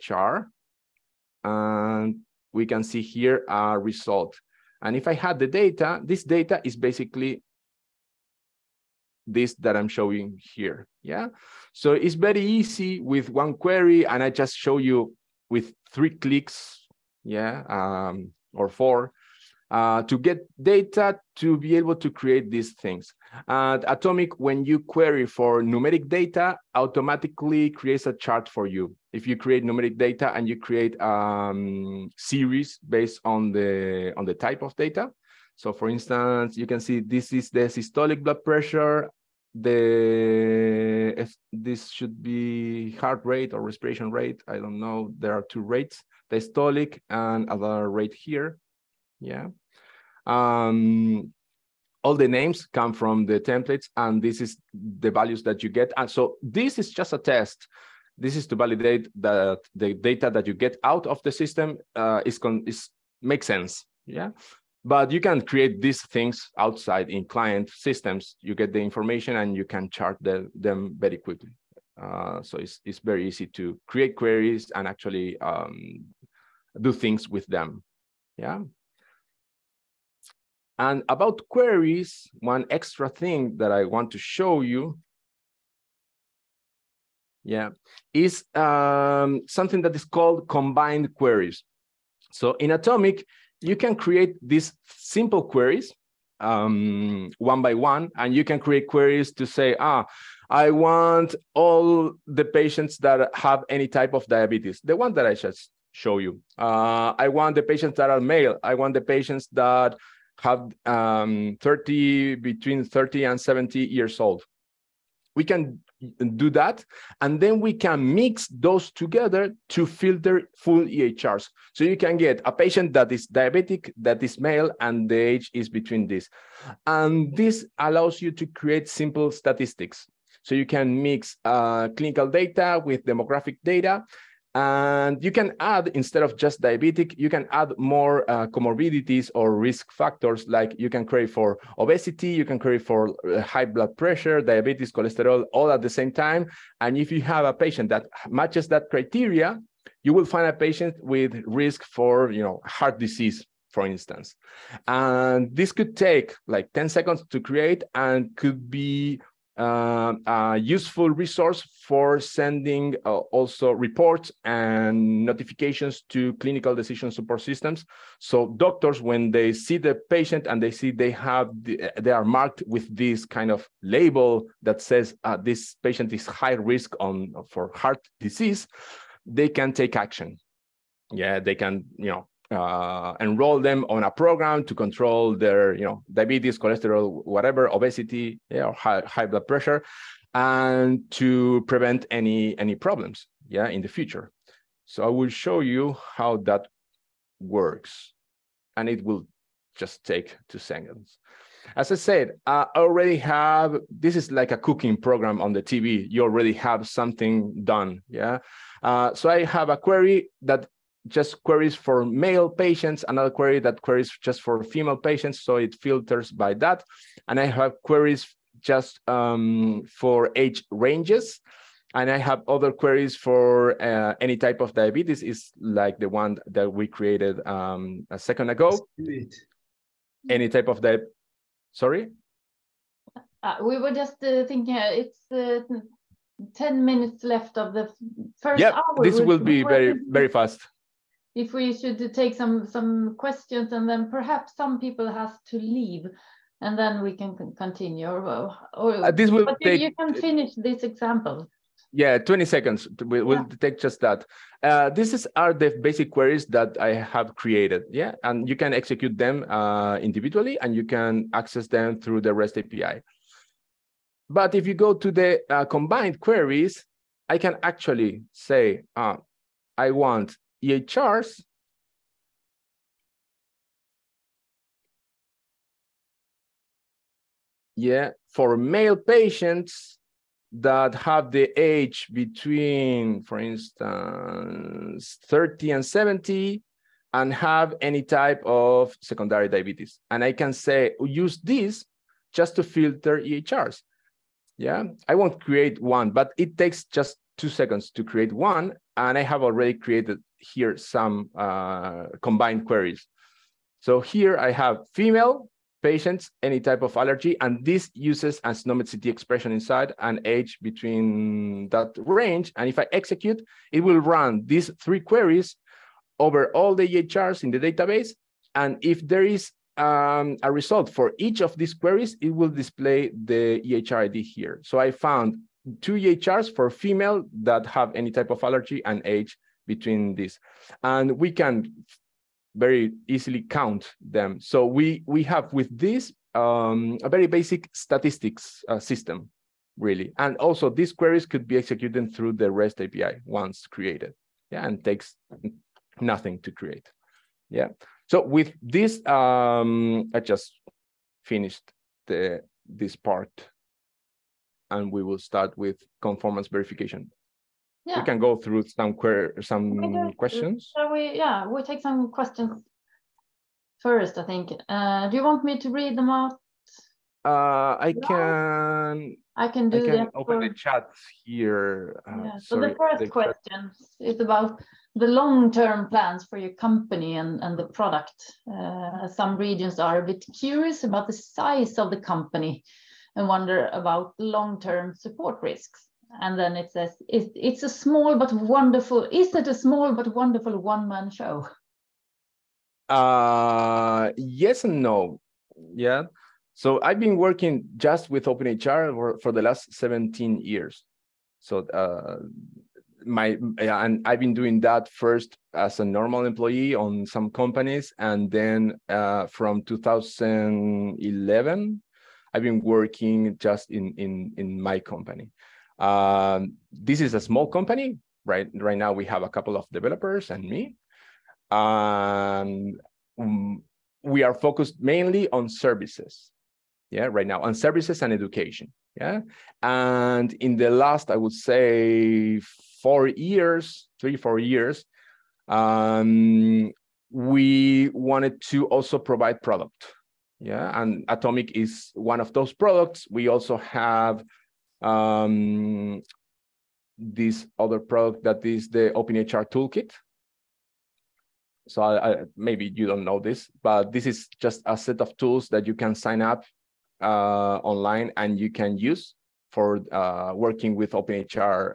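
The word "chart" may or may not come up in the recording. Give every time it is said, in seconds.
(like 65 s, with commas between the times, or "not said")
28 s, 69 s.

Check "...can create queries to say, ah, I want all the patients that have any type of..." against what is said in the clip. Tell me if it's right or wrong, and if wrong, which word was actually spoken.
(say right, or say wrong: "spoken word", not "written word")
right.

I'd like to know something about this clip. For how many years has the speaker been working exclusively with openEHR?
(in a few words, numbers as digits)
17.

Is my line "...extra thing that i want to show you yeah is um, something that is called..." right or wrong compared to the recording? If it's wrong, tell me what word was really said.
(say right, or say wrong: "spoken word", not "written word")
right.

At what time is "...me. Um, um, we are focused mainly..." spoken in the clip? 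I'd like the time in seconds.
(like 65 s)
420 s.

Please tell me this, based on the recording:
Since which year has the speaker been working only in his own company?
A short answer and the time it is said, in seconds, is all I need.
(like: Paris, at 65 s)
2011, at 409 s.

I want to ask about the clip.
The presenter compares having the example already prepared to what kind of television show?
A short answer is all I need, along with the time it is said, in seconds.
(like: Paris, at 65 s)
A cooking program, at 204 s.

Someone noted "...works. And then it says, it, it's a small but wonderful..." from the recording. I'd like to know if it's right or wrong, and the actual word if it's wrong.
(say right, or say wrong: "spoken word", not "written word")
wrong: "risks", not "works".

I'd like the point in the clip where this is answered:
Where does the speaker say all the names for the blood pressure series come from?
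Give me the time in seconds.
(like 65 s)
53 s.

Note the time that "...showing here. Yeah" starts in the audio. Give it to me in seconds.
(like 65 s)
9 s.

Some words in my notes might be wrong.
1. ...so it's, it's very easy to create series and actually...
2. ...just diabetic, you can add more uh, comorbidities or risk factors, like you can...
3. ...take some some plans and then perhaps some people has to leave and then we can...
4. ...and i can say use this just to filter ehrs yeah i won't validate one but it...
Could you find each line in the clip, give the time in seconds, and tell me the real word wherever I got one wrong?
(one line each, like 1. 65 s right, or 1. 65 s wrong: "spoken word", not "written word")
1. 72 s wrong: "queries", not "series"
2. 136 s right
3. 242 s wrong: "questions", not "plans"
4. 290 s wrong: "create", not "validate".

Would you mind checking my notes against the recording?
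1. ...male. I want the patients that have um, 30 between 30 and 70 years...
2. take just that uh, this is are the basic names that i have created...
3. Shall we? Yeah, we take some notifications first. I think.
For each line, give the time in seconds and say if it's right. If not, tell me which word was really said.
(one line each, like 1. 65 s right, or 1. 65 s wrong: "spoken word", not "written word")
1. 108 s right
2. 253 s wrong: "queries", not "names"
3. 360 s wrong: "questions", not "notifications".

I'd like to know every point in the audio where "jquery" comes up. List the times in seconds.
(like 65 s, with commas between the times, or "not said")
not said.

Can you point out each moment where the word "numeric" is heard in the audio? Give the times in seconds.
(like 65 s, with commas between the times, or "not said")
25 s, 29 s.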